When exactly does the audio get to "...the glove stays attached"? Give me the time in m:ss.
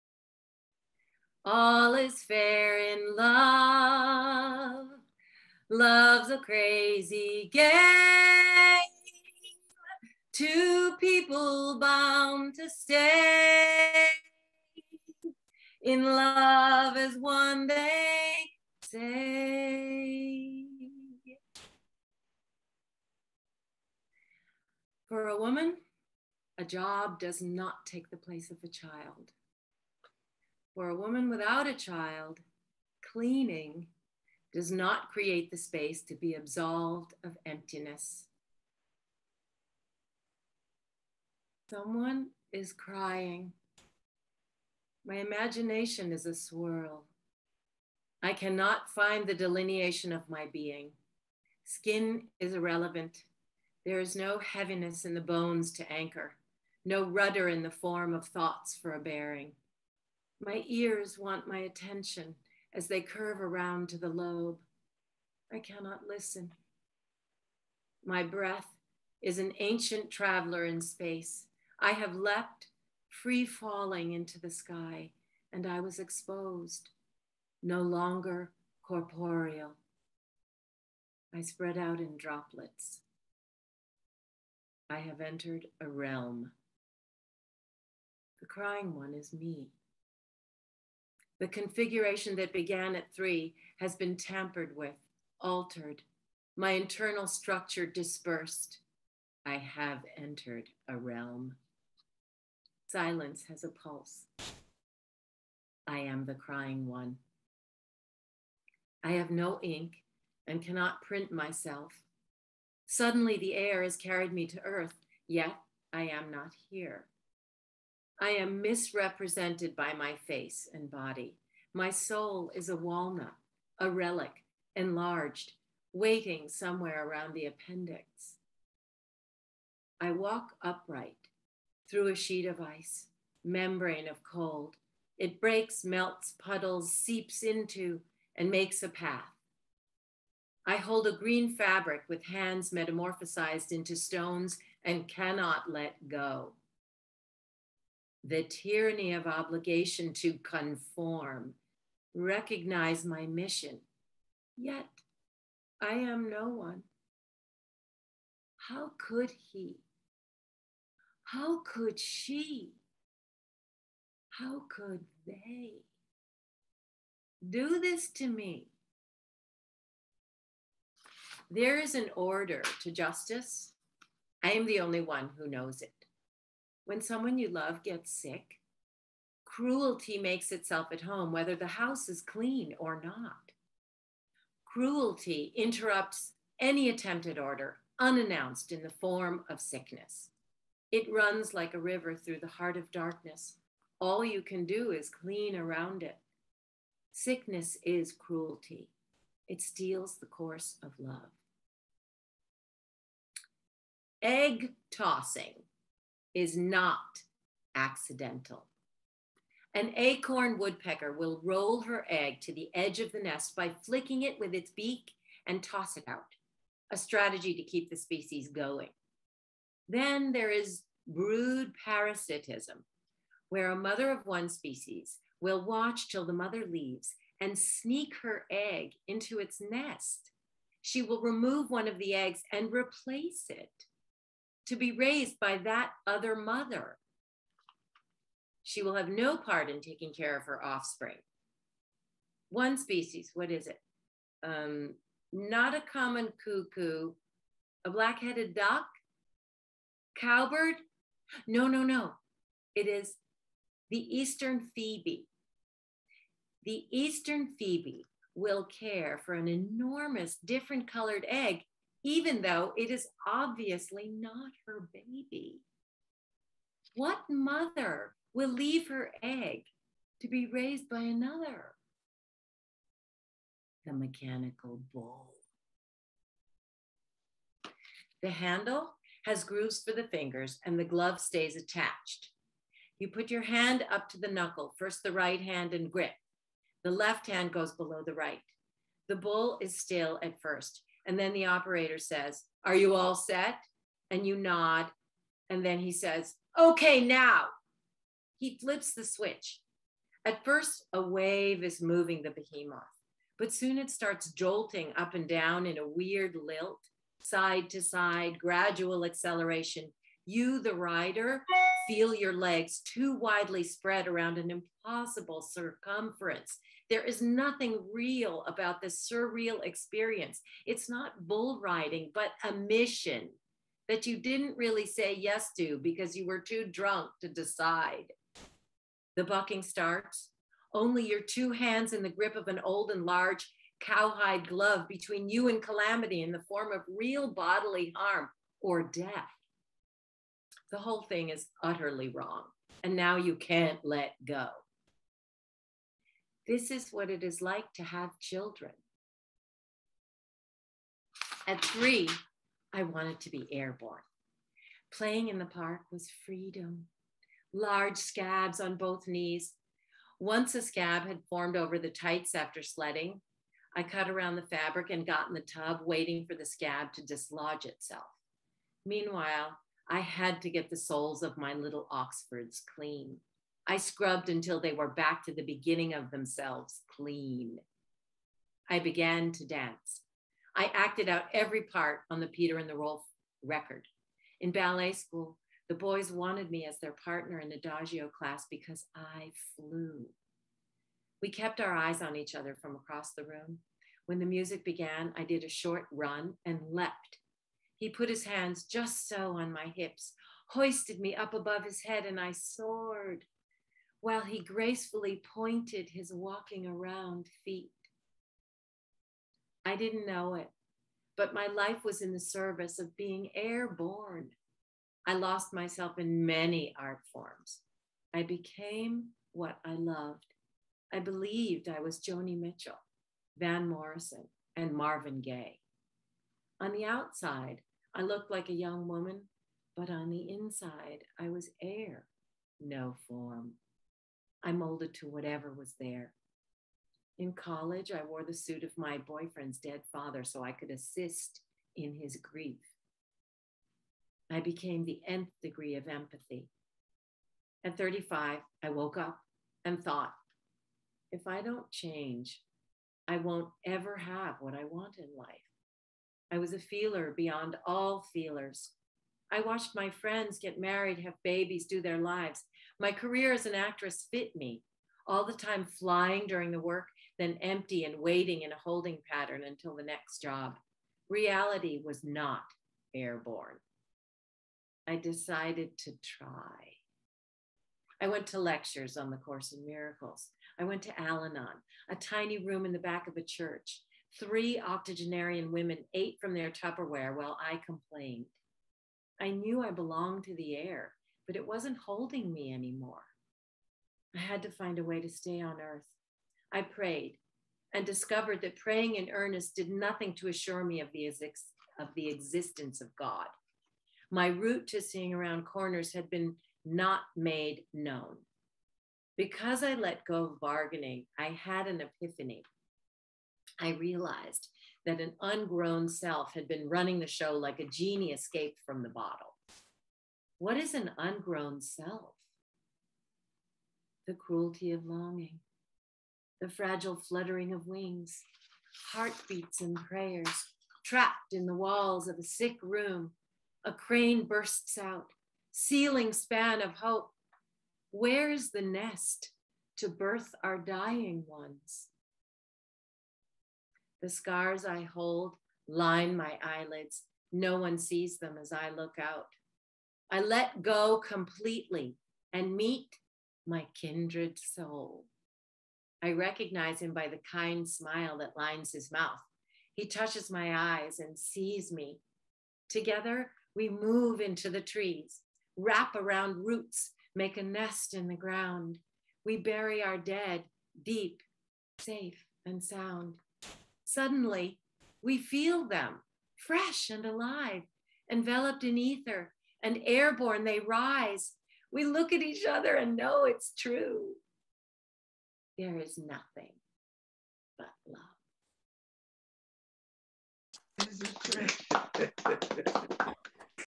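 4:40.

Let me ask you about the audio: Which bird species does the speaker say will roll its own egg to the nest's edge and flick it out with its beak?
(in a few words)
Acorn woodpecker.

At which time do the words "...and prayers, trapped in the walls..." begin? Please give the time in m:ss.
8:49.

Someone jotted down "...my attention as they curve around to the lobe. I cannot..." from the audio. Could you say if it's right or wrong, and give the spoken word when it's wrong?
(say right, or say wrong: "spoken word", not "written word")
right.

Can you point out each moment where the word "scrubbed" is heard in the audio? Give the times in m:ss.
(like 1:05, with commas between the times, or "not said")
6:13.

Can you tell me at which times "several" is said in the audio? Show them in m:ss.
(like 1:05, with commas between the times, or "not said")
not said.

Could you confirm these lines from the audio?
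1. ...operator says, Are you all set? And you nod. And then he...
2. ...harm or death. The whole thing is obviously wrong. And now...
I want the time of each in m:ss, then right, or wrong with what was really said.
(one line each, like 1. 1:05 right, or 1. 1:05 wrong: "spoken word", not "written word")
1. 4:51 right
2. 5:37 wrong: "utterly", not "obviously".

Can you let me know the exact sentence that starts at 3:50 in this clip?
She will remove one of the eggs and replace it to be raised by that other mother.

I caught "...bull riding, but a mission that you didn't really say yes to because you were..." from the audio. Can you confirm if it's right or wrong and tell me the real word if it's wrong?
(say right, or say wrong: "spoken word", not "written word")
right.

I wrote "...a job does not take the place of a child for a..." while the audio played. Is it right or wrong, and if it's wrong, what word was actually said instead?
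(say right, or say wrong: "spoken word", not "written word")
right.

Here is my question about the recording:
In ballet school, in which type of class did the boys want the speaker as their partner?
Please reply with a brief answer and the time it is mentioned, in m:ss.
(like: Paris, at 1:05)
Adagio, at 6:27.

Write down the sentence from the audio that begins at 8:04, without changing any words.
Three octogenarian women ate from their Tupperware while I complained.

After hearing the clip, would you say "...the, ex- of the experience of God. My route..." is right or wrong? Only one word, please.
wrong.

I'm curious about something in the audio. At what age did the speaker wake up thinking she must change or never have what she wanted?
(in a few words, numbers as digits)
35.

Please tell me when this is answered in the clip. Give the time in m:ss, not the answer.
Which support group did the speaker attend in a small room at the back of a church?
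8:01.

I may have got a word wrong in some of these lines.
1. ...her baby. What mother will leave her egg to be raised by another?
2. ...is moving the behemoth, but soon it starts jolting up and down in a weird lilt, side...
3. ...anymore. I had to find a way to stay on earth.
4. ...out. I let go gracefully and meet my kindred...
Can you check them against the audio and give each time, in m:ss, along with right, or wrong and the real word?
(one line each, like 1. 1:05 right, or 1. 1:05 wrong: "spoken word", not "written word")
1. 4:24 right
2. 5:01 right
3. 8:12 right
4. 9:08 wrong: "completely", not "gracefully".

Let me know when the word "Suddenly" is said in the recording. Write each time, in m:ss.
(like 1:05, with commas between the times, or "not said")
1:52, 9:33.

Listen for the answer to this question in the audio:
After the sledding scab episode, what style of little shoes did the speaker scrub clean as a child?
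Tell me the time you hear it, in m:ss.
6:11.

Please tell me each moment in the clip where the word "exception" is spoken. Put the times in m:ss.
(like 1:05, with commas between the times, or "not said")
not said.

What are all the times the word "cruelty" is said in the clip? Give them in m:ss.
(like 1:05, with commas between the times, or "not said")
2:59, 3:04, 3:18, 8:44.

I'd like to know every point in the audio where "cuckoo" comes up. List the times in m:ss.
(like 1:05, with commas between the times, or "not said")
4:06.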